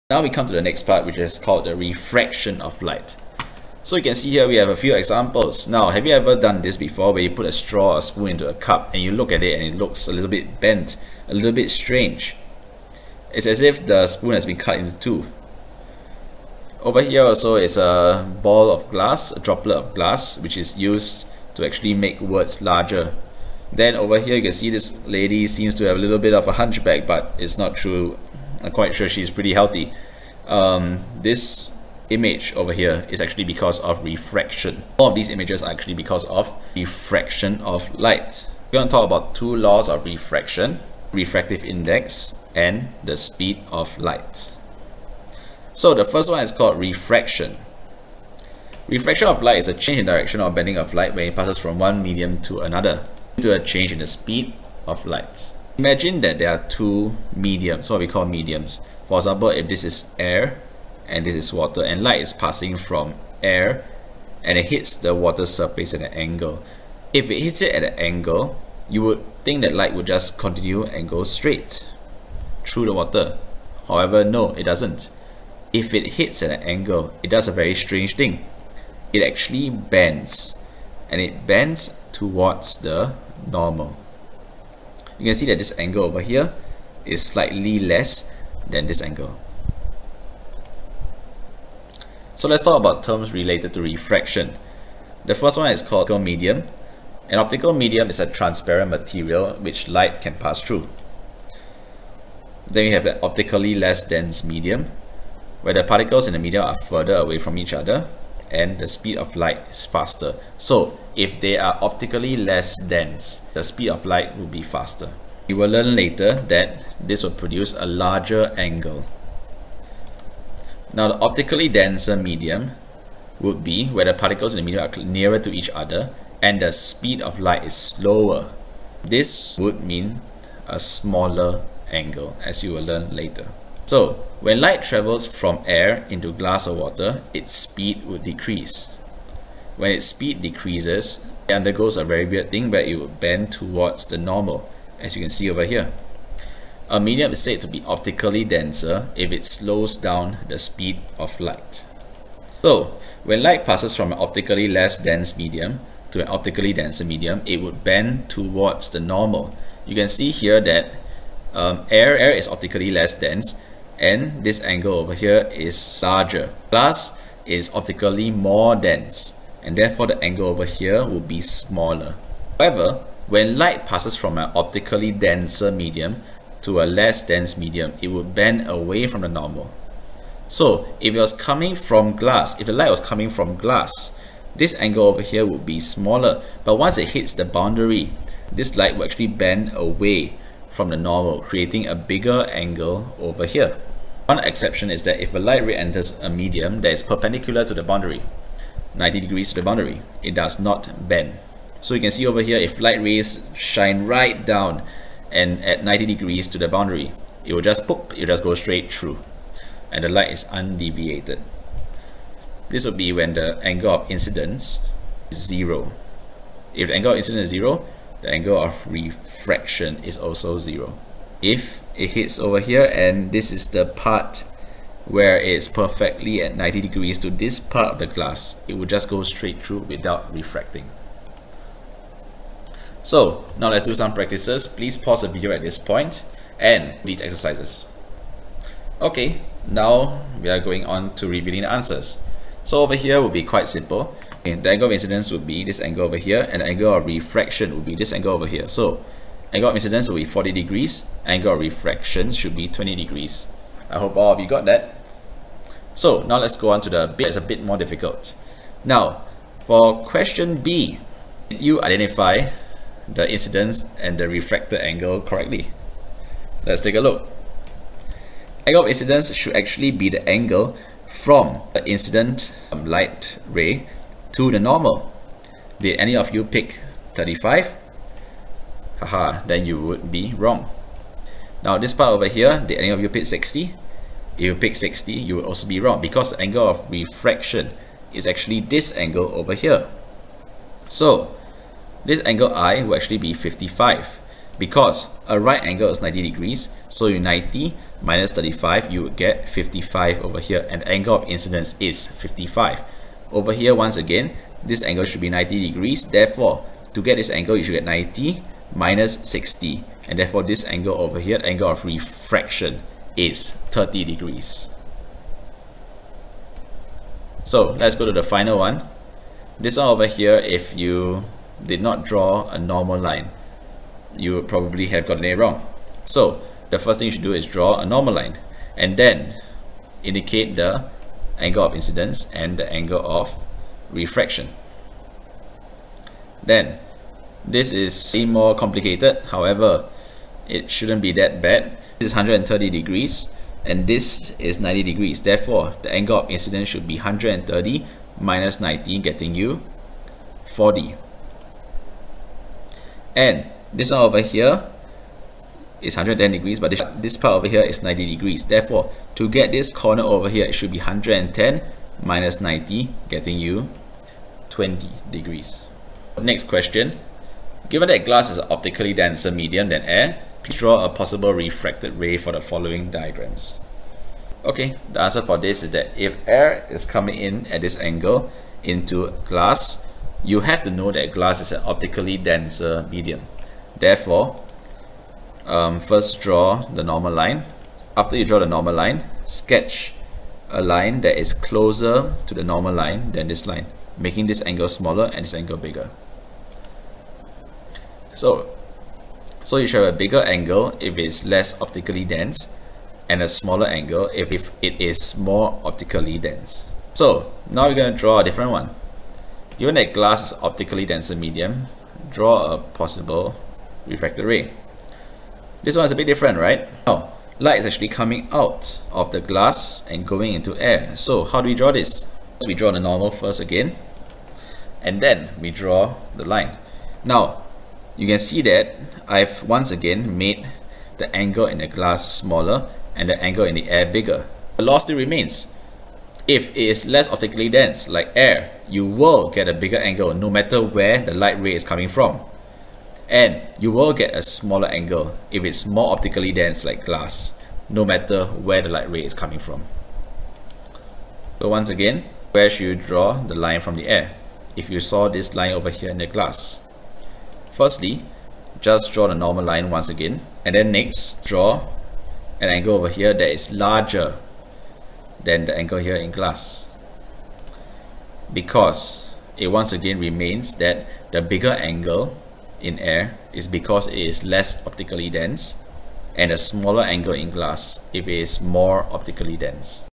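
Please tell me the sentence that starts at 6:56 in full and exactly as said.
Now, oh, light is actually coming out of the glass and going into air.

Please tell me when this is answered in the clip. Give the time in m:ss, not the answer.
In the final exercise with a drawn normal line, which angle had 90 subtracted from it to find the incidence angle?
5:42.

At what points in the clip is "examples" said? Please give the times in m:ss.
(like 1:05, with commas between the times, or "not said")
0:04, 0:59.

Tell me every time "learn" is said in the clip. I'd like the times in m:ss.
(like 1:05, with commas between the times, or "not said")
1:55, 2:12.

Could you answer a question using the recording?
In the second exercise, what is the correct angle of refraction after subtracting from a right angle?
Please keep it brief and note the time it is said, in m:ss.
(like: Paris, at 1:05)
30 degrees, at 5:13.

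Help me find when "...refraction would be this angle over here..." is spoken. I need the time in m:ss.
4:07.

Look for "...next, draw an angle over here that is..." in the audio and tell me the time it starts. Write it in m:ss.
7:40.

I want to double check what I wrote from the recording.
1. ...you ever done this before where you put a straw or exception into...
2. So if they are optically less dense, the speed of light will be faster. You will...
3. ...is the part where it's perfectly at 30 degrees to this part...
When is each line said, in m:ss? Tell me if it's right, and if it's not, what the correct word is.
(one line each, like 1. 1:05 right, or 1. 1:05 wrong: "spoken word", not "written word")
1. 0:06 wrong: "spoon", not "exception"
2. 1:50 right
3. 3:43 wrong: "90", not "30".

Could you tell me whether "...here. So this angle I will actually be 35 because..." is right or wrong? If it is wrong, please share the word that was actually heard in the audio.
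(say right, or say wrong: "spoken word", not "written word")
wrong: "55", not "35".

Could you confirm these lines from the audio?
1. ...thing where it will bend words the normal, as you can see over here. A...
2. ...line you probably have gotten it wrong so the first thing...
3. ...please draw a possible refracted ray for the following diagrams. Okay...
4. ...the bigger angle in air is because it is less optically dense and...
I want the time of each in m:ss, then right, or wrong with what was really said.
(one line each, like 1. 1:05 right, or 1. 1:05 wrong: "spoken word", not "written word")
1. 2:22 wrong: "towards", not "words"
2. 5:22 right
3. 6:10 right
4. 7:51 right.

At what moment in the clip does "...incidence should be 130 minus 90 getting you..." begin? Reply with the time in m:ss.
5:46.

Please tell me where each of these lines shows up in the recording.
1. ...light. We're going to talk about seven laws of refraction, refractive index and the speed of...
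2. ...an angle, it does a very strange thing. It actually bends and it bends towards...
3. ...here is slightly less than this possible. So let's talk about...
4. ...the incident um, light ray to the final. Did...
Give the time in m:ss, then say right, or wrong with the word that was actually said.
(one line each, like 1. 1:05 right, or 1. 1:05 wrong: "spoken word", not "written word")
1. 0:37 wrong: "two", not "seven"
2. 1:16 right
3. 1:26 wrong: "angle", not "possible"
4. 4:31 wrong: "normal", not "final".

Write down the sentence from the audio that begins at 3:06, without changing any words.
But once it hits the boundary, this light will actually bend away from the normal, creating a bigger angle over here.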